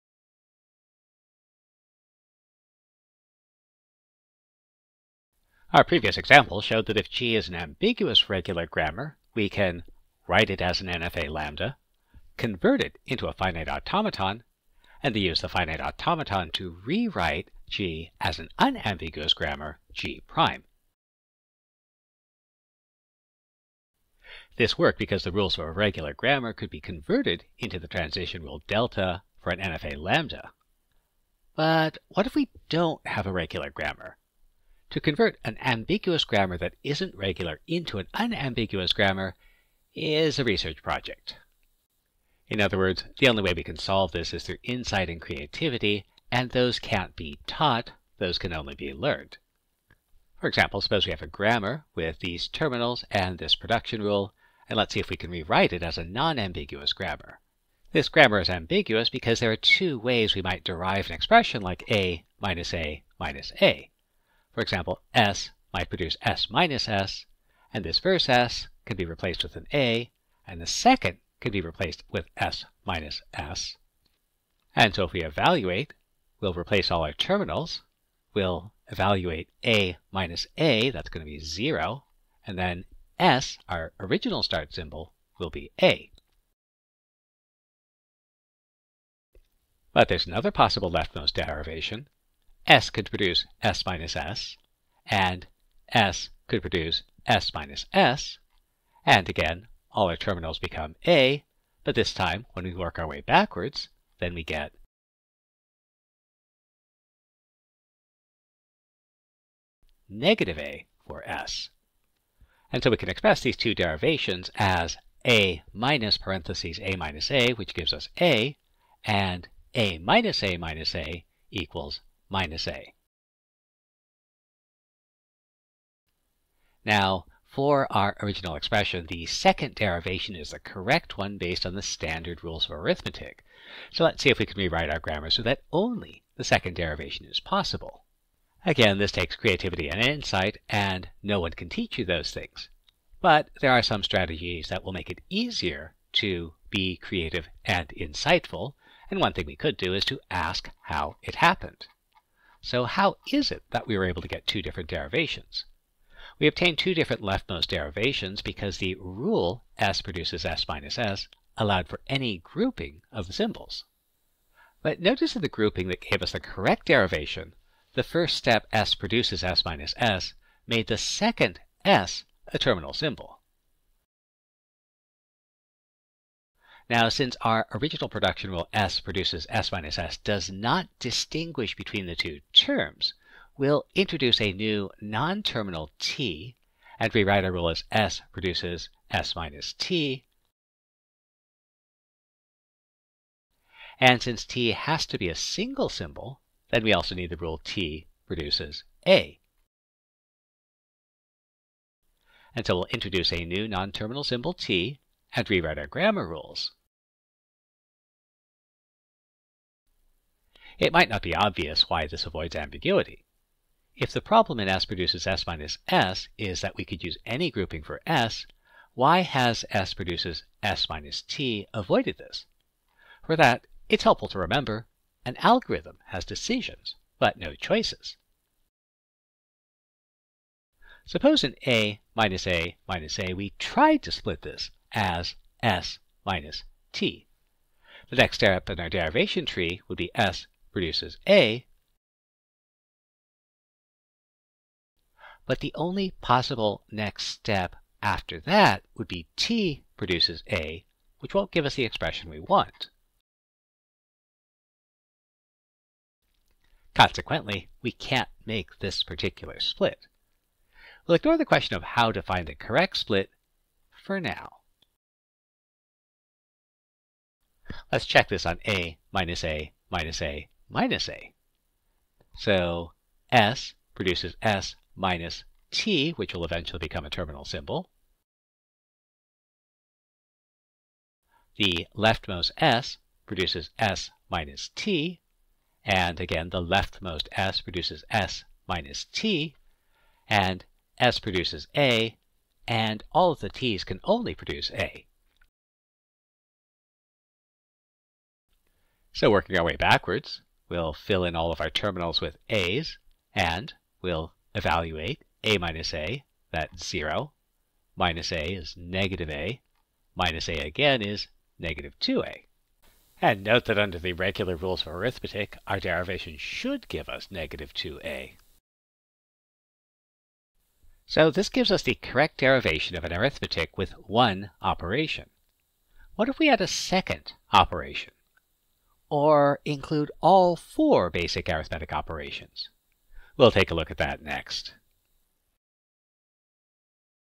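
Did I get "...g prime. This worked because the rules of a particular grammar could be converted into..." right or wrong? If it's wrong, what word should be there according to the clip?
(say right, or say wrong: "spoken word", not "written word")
wrong: "regular", not "particular".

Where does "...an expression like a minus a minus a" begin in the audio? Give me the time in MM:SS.
01:01.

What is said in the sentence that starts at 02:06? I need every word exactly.
Now, for our original expression, the second derivation is the correct one based on the standard rules of arithmetic.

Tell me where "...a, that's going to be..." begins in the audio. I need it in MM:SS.
01:20.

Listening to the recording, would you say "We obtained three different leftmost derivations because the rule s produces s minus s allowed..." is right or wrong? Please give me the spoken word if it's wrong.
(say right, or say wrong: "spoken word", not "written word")
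wrong: "two", not "three".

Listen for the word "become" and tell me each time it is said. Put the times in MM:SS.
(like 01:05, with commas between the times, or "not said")
01:40, 04:36.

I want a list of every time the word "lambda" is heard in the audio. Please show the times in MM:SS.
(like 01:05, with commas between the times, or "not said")
00:11, 00:29.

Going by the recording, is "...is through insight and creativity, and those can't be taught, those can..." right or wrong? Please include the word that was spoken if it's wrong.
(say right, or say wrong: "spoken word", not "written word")
right.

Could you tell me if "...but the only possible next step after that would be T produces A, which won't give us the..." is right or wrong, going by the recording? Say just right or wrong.
right.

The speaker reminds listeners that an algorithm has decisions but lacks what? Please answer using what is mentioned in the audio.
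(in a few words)
Choices.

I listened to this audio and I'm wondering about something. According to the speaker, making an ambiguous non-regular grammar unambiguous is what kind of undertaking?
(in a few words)
A research project.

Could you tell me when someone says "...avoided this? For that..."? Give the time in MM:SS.
03:41.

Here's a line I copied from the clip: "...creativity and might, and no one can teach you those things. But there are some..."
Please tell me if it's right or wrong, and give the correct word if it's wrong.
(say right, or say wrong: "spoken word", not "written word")
wrong: "insight", not "might".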